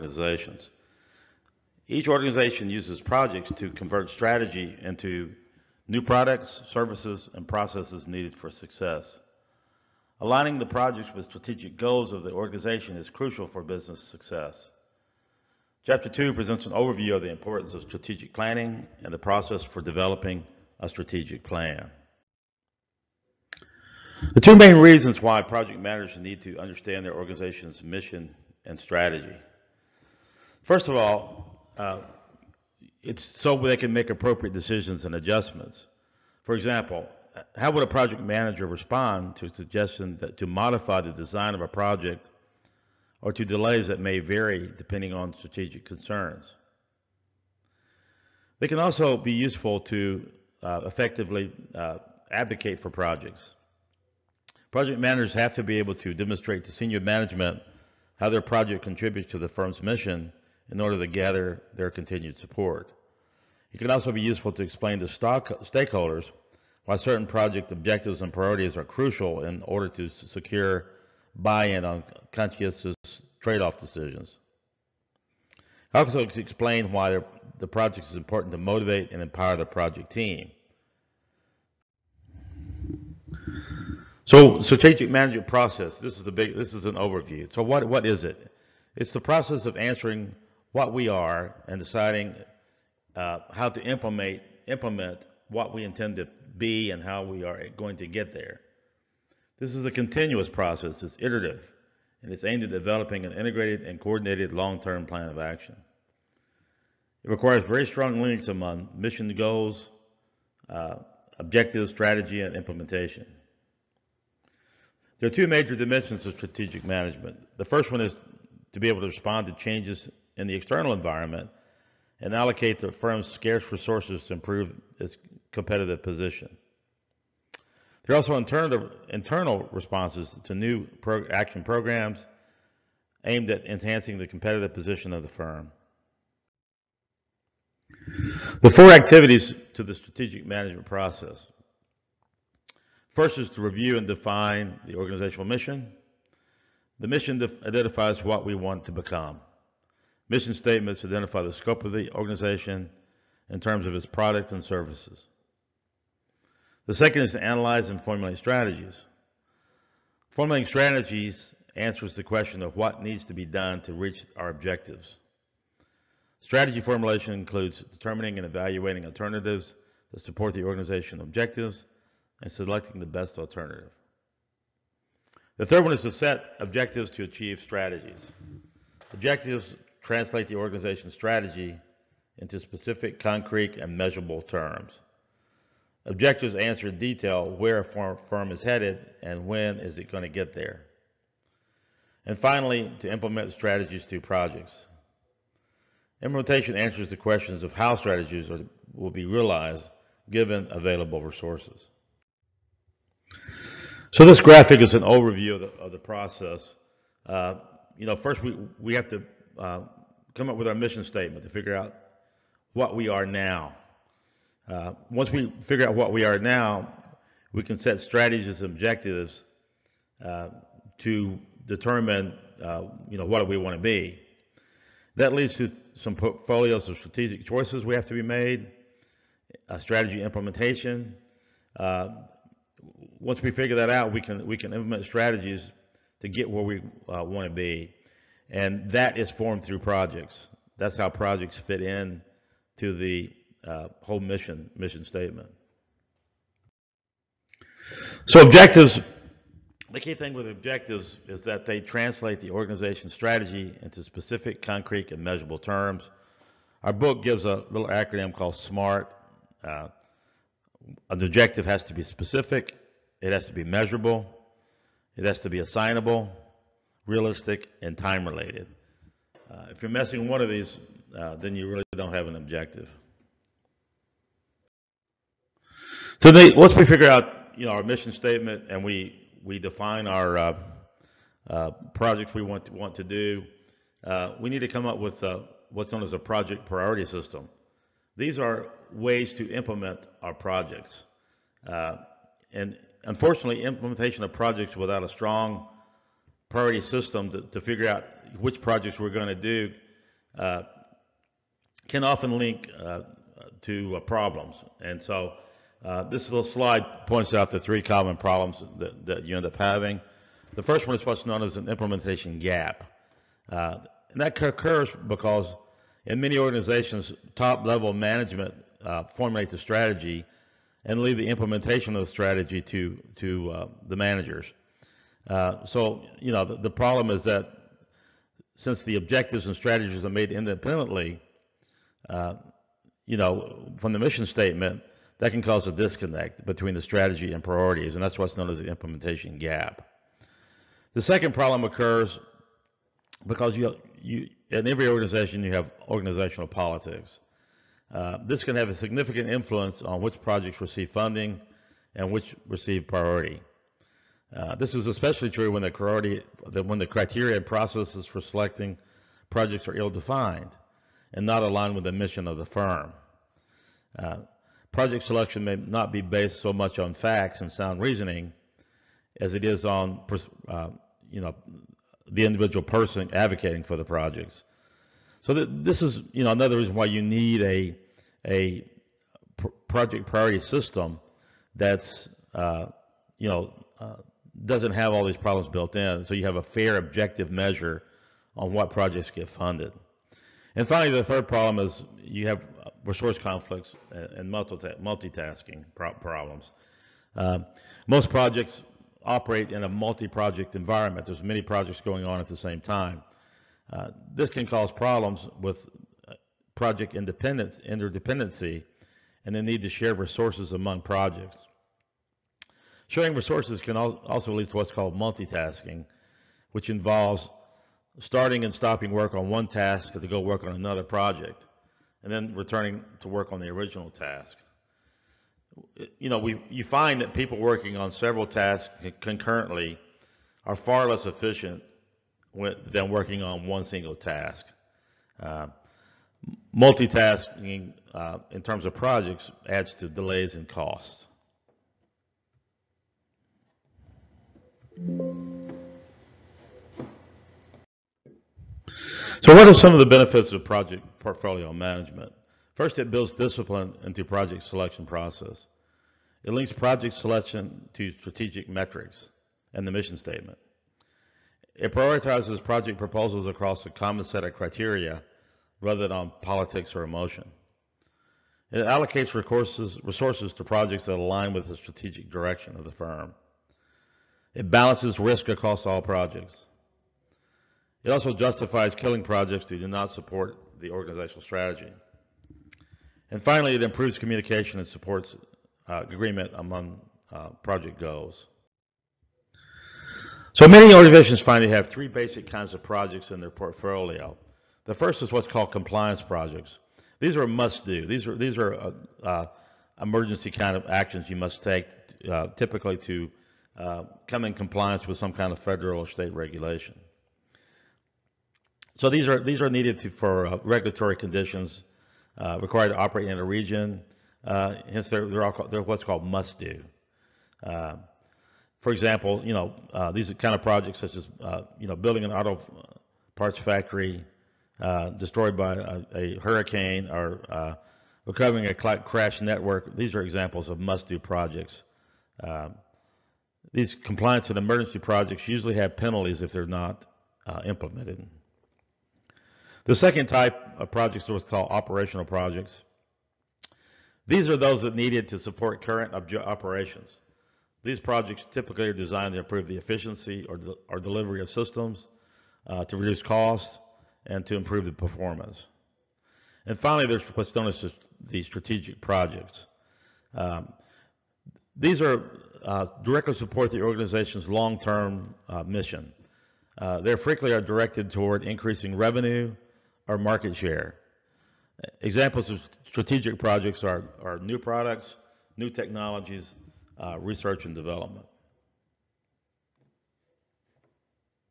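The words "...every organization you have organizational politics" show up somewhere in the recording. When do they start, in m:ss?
5:44.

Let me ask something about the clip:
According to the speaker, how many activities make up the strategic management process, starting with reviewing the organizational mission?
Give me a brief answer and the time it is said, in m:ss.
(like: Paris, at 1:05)
4, at 2:18.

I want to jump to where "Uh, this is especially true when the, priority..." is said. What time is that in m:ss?
5:54.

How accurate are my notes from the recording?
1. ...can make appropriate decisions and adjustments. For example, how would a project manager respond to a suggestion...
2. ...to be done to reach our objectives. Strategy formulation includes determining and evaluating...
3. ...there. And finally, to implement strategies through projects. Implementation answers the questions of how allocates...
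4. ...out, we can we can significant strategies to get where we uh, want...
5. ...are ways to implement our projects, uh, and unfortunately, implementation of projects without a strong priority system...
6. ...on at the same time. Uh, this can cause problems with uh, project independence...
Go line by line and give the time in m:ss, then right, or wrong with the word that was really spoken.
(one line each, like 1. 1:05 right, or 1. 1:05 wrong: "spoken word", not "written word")
1. 0:33 right
2. 2:43 right
3. 3:10 wrong: "strategies", not "allocates"
4. 3:53 wrong: "implement", not "significant"
5. 4:48 right
6. 6:42 right.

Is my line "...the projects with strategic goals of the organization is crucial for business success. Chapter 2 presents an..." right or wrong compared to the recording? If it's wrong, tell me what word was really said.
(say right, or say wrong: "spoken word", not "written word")
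right.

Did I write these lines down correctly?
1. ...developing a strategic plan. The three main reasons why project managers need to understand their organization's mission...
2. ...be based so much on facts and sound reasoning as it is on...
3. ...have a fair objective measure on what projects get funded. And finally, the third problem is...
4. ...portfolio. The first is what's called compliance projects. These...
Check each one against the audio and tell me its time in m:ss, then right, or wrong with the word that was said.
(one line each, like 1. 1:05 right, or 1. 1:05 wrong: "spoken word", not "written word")
1. 0:19 wrong: "two", not "three"
2. 6:05 right
3. 6:26 right
4. 8:13 right.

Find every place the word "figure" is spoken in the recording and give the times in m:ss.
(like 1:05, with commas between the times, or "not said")
3:31, 3:35, 3:53, 4:36, 4:57.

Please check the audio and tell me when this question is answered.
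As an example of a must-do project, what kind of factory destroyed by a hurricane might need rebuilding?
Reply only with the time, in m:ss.
8:42.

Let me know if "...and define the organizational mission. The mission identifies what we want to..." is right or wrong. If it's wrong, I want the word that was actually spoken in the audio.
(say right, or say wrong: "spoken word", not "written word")
right.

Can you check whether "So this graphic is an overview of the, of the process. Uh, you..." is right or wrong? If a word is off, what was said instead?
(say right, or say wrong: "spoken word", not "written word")
right.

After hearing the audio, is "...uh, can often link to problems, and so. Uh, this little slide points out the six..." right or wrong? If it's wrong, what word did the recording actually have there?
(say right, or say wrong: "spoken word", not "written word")
wrong: "three", not "six".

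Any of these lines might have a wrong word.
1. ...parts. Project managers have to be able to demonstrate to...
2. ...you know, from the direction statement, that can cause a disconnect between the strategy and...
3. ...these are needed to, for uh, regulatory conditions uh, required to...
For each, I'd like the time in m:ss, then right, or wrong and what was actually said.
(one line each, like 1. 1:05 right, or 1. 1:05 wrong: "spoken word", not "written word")
1. 0:52 wrong: "projects", not "parts"
2. 5:33 wrong: "mission", not "direction"
3. 8:29 right.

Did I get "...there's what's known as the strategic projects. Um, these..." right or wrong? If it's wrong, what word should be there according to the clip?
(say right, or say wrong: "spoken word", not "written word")
right.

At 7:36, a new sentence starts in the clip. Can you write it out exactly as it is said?
It links project selection to strategic metrics and the mission statement.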